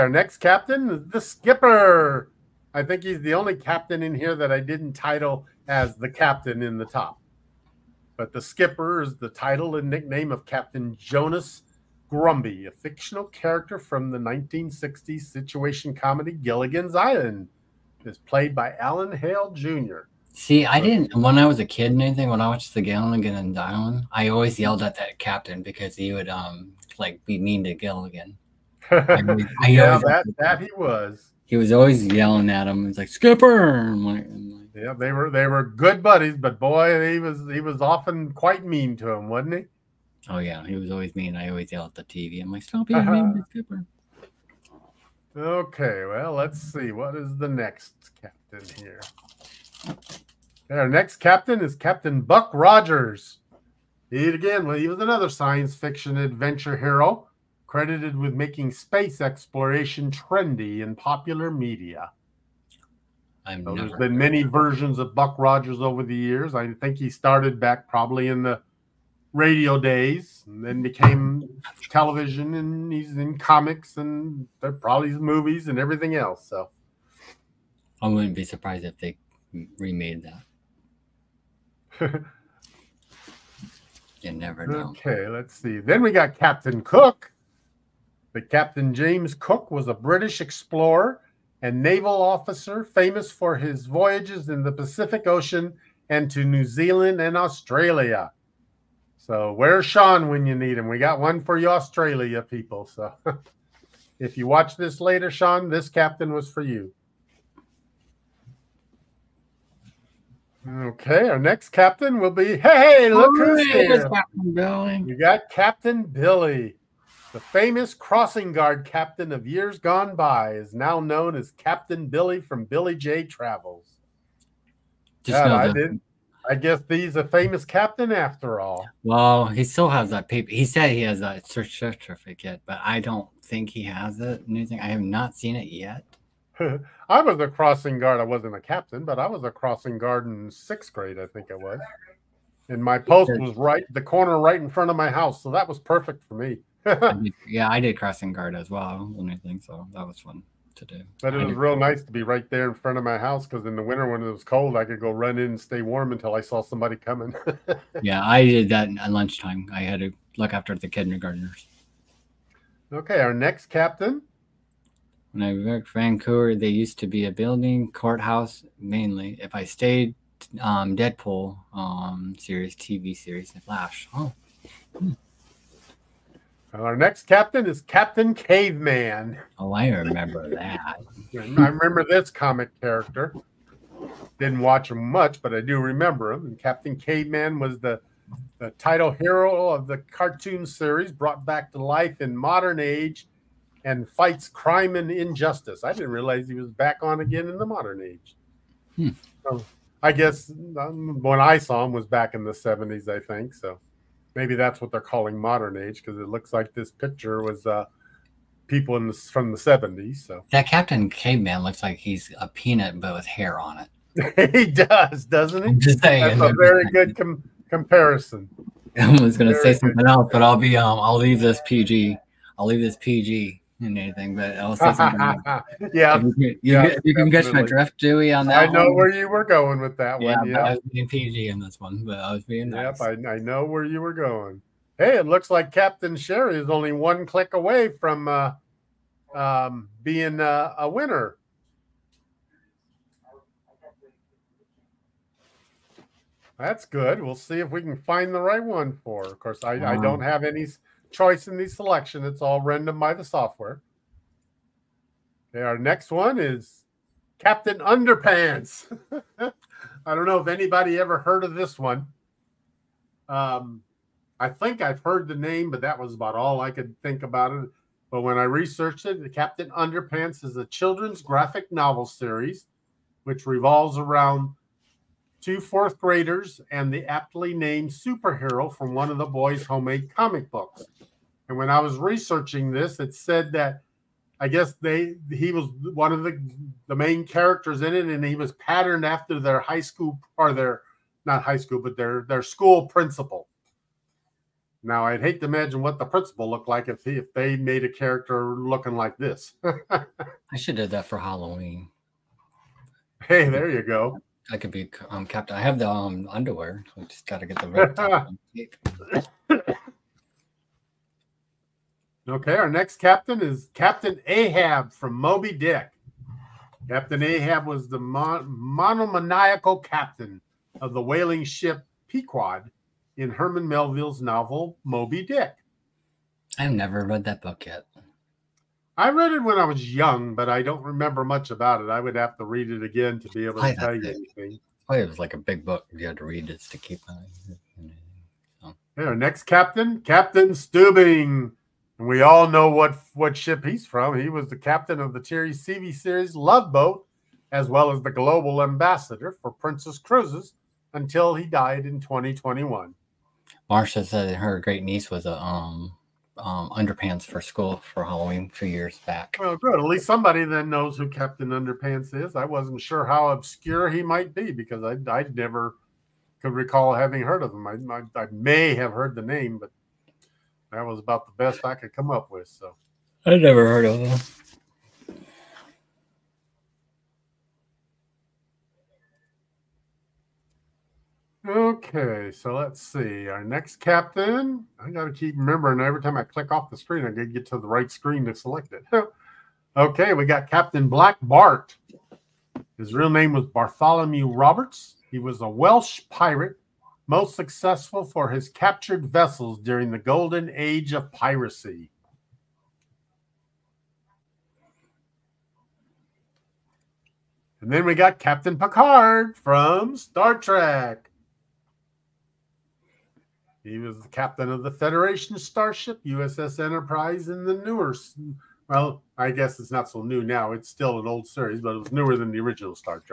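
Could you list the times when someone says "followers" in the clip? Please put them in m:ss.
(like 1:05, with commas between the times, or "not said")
not said.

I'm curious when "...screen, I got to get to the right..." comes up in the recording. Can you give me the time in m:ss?
6:26.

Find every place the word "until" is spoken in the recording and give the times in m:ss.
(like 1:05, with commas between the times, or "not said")
2:36, 5:50.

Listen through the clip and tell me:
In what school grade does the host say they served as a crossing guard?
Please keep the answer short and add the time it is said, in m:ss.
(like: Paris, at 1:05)
sixth grade, at 2:20.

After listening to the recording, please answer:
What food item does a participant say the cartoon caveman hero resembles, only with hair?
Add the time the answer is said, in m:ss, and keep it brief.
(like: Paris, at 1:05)
a peanut, at 3:32.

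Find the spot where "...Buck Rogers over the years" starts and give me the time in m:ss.
1:05.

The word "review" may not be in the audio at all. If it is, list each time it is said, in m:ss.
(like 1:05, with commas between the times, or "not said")
not said.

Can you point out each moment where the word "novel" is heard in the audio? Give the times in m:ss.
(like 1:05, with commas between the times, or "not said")
4:31, 5:24.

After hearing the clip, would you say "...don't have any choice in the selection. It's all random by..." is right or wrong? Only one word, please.
right.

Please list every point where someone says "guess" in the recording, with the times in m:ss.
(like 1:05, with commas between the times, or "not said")
2:06, 3:20, 4:44, 6:59.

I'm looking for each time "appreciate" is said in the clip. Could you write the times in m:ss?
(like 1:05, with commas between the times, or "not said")
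not said.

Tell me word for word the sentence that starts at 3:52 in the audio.
Yep, I, I, know where you were going.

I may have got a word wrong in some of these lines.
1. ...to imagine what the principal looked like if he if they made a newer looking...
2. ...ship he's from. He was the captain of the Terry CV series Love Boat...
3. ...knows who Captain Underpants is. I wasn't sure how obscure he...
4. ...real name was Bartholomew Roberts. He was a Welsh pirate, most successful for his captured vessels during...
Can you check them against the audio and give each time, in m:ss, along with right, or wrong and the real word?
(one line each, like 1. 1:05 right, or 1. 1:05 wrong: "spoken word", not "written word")
1. 4:55 wrong: "character", not "newer"
2. 5:43 right
3. 6:00 right
4. 6:32 right.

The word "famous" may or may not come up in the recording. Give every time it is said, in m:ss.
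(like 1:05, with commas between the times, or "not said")
1:32, 1:57, 2:07.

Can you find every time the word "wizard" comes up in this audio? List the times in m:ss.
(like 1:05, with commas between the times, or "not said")
not said.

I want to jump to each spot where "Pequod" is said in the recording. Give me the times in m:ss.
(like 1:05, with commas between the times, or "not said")
5:22.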